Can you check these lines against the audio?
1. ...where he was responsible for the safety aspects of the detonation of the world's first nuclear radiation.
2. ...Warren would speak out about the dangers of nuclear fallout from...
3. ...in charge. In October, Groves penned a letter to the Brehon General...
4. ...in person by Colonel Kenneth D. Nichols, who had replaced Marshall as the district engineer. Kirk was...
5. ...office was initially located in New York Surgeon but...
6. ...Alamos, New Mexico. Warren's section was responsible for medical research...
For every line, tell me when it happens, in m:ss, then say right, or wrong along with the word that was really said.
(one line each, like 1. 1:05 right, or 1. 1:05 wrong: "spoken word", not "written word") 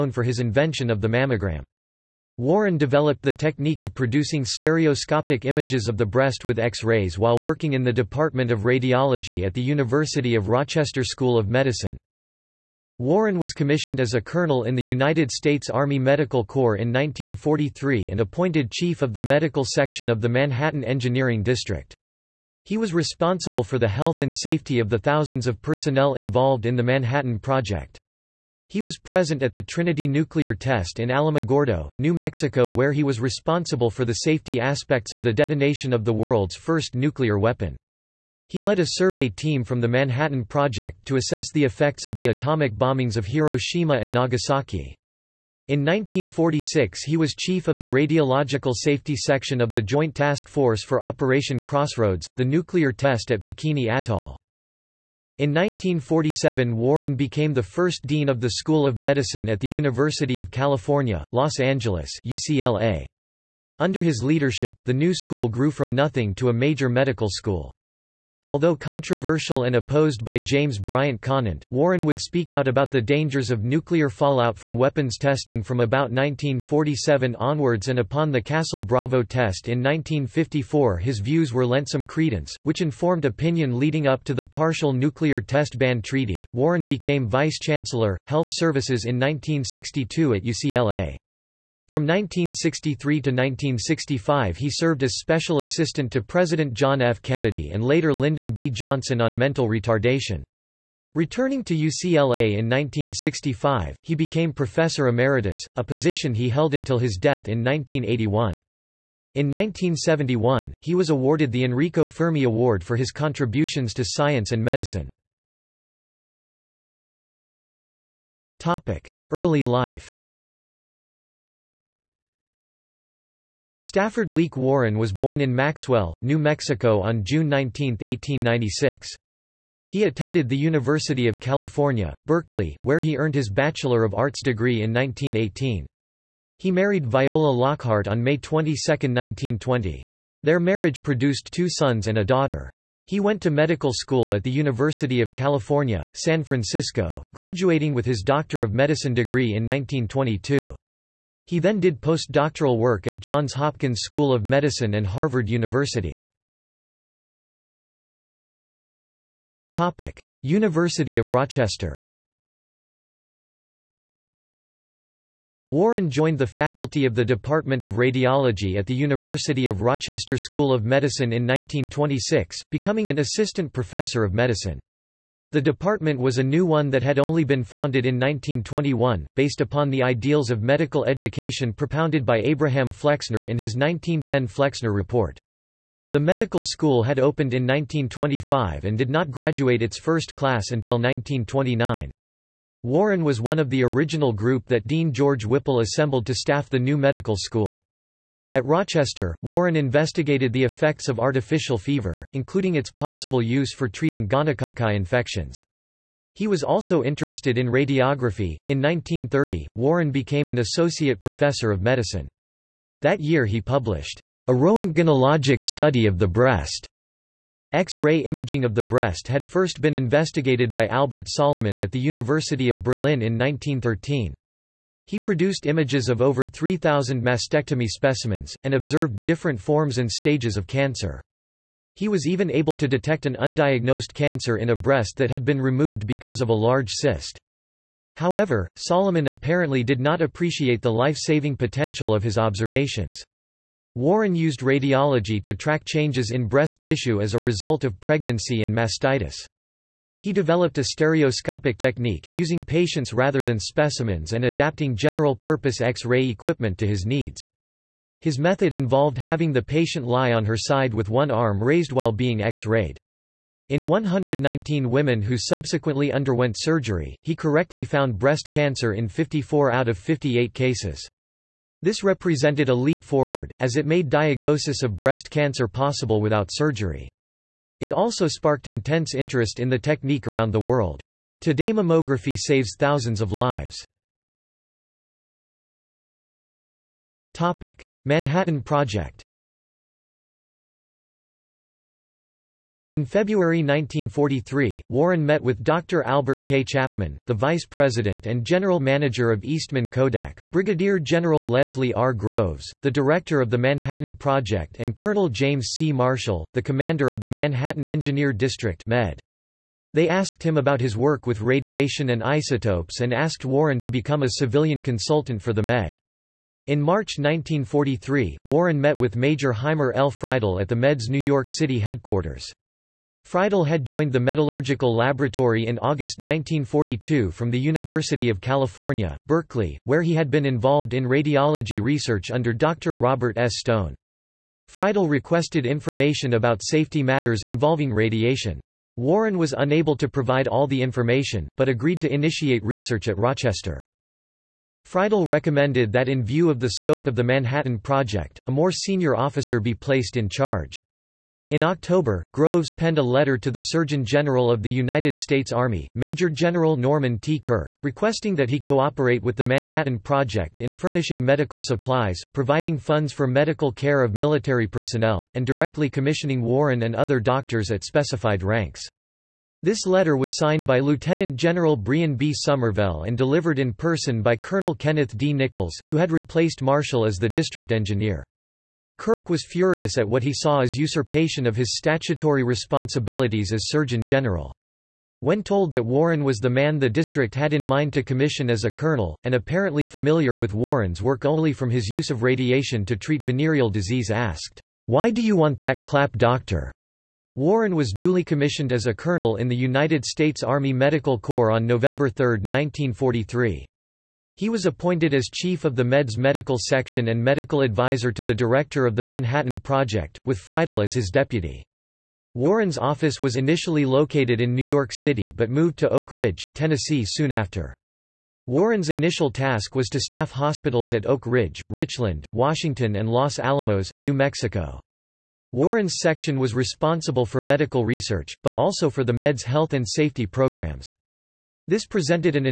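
1. 0:32 wrong: "weapon", not "radiation"
2. 1:11 right
3. 5:50 wrong: "Surgeon", not "Brehon"
4. 6:13 right
5. 6:52 wrong: "City", not "Surgeon"
6. 7:03 right.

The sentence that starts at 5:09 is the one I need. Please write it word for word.
They asked him about his work with radiation and isotopes and asked Warren to become a civilian consultant for the Med.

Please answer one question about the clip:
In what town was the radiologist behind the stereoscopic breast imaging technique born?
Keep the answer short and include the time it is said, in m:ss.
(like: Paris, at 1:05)
Maxwell, New Mexico, at 2:05.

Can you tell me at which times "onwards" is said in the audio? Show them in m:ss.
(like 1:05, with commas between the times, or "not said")
1:17.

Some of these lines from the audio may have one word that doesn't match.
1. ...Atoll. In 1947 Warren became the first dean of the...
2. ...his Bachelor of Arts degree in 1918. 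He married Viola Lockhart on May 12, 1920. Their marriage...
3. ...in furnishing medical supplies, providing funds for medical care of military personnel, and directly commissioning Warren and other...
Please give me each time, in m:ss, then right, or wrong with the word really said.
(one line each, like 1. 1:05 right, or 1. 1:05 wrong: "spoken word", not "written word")
1. 0:53 right
2. 2:13 wrong: "22", not "12"
3. 6:00 right.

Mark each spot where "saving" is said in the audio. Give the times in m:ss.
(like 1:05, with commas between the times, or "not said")
4:00.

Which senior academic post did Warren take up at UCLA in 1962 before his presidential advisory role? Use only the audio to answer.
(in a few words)
Vice Chancellor, Health Services.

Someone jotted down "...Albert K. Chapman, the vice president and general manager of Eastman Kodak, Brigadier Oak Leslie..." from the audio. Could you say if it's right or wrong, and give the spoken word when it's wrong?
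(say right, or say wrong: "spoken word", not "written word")
wrong: "General", not "Oak".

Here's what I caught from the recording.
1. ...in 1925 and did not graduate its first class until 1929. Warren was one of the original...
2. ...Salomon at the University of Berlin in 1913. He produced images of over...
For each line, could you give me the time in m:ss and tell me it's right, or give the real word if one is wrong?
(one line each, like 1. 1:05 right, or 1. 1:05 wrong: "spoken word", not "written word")
1. 3:07 right
2. 3:41 right.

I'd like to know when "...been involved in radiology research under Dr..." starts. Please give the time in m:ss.
5:30.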